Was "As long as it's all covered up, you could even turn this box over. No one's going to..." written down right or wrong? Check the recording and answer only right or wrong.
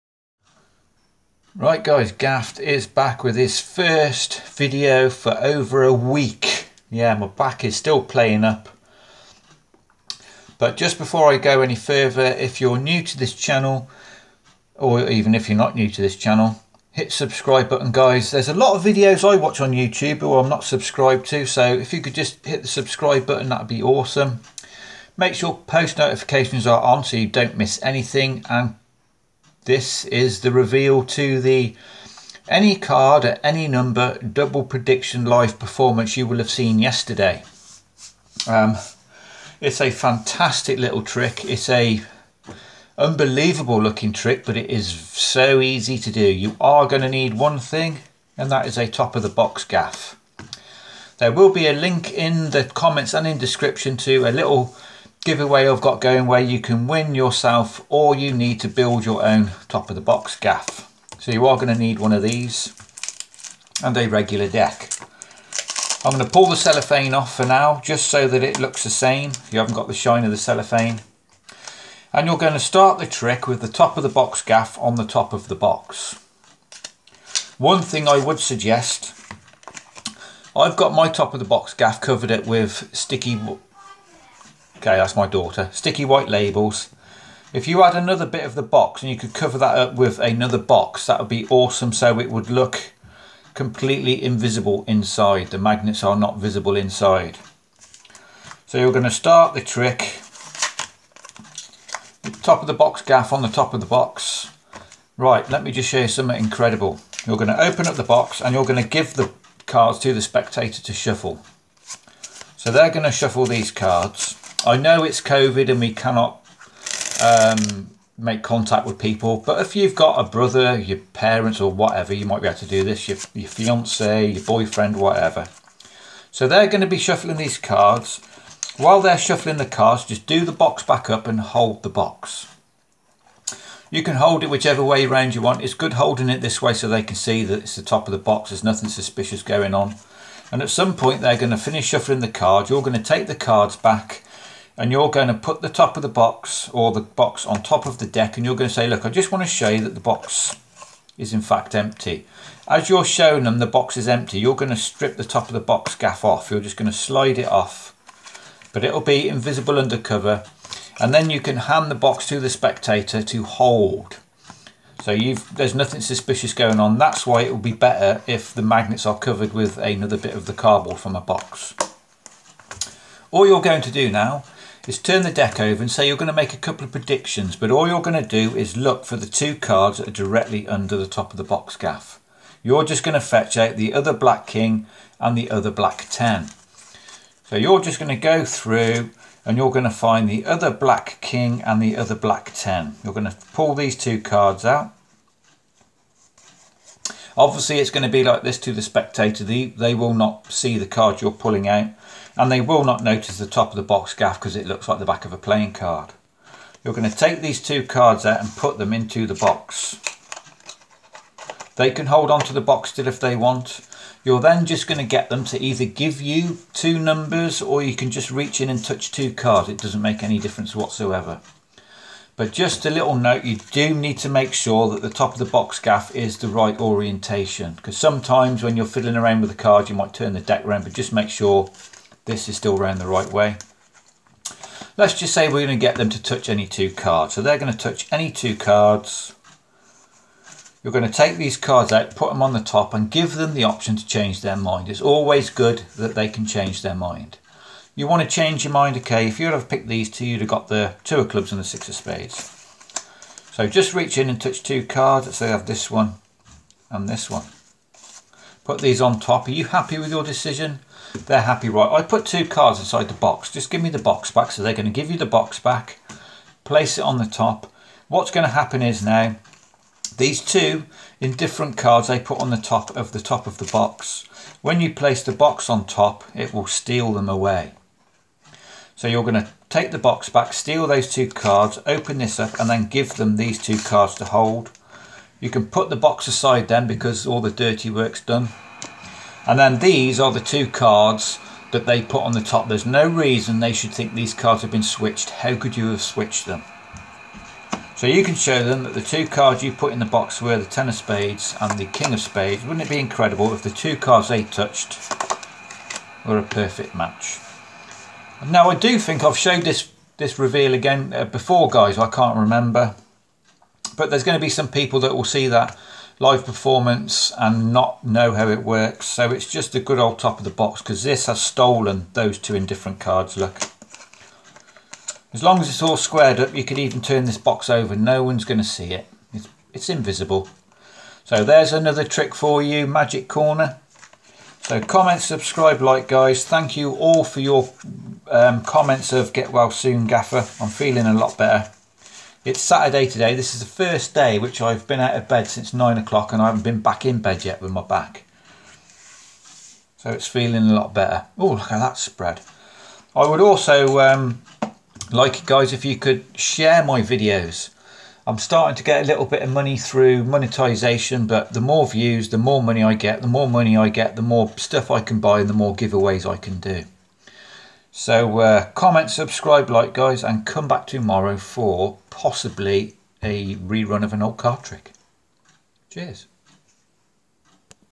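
wrong.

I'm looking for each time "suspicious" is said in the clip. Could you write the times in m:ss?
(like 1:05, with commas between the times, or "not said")
2:18, 2:45.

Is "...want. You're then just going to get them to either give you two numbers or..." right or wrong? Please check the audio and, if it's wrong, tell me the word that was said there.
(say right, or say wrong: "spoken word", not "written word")
right.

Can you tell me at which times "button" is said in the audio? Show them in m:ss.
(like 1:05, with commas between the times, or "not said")
0:17, 0:23.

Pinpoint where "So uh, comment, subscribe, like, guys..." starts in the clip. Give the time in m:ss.
6:07.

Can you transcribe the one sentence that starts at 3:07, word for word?
So you're just going to go through and you're going to find the other black king and the other black 10.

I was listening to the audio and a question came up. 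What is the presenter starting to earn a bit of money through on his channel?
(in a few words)
monetization.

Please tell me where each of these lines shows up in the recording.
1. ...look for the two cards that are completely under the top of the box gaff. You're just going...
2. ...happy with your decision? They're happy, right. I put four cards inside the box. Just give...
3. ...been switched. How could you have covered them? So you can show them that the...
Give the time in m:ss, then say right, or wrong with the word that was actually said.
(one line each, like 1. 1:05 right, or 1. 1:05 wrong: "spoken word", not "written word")
1. 2:58 wrong: "directly", not "completely"
2. 4:19 wrong: "two", not "four"
3. 4:54 wrong: "switched", not "covered".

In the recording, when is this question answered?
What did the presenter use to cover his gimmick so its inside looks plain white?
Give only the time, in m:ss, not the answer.
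1:25.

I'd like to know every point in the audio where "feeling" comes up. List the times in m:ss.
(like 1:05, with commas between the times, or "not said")
5:40, 5:50.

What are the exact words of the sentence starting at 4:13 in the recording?
So just reach in and touch two cards.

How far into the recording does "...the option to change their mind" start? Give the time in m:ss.
4:03.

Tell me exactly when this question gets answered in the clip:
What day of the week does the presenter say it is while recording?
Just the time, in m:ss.
5:42.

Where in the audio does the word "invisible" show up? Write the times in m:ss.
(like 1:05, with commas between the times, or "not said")
1:34, 2:39, 5:29.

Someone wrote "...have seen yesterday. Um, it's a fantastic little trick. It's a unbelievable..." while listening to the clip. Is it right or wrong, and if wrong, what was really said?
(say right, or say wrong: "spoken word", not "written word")
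right.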